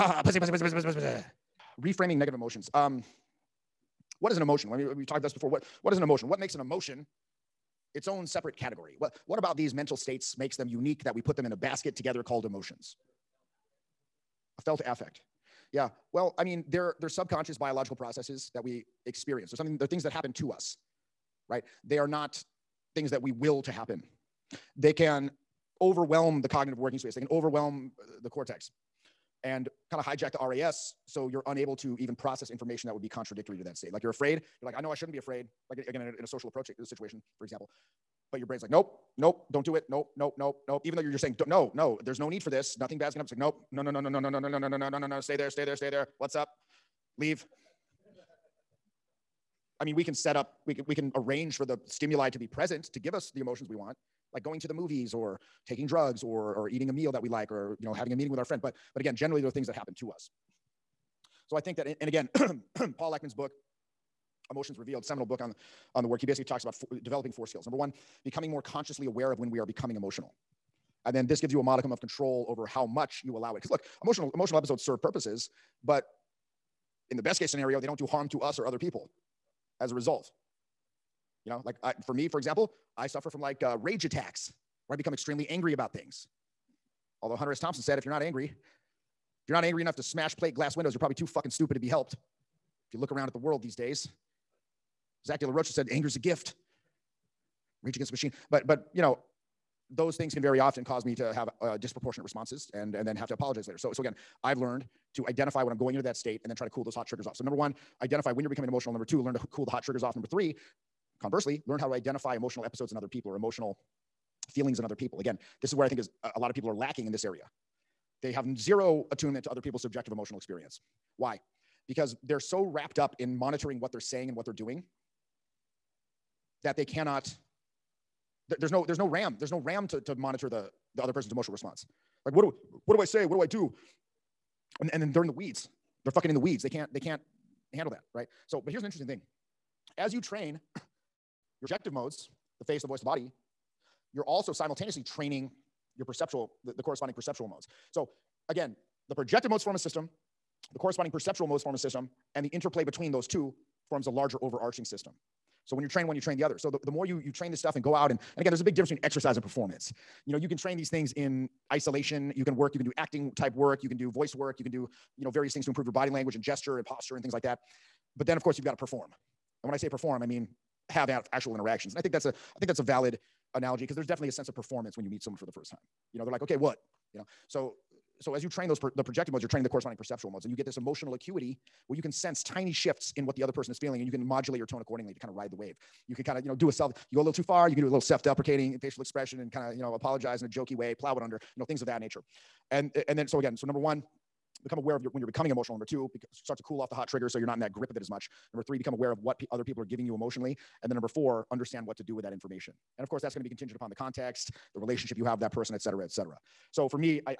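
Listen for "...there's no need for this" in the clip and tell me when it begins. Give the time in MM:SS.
00:42.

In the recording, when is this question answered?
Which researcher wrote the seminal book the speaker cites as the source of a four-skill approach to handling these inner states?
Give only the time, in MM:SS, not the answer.
01:02.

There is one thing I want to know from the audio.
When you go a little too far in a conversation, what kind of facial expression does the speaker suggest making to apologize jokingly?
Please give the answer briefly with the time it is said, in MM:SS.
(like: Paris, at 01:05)
self-deprecating, at 03:07.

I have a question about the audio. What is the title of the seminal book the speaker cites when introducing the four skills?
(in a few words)
Emotions Revealed.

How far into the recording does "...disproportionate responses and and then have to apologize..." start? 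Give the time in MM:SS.
01:41.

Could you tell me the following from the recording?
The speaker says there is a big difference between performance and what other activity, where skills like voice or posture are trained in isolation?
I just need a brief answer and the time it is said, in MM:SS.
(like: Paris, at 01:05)
exercise, at 02:39.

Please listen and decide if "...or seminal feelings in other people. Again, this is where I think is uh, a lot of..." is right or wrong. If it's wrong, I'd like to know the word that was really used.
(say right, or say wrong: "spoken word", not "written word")
wrong: "emotional", not "seminal".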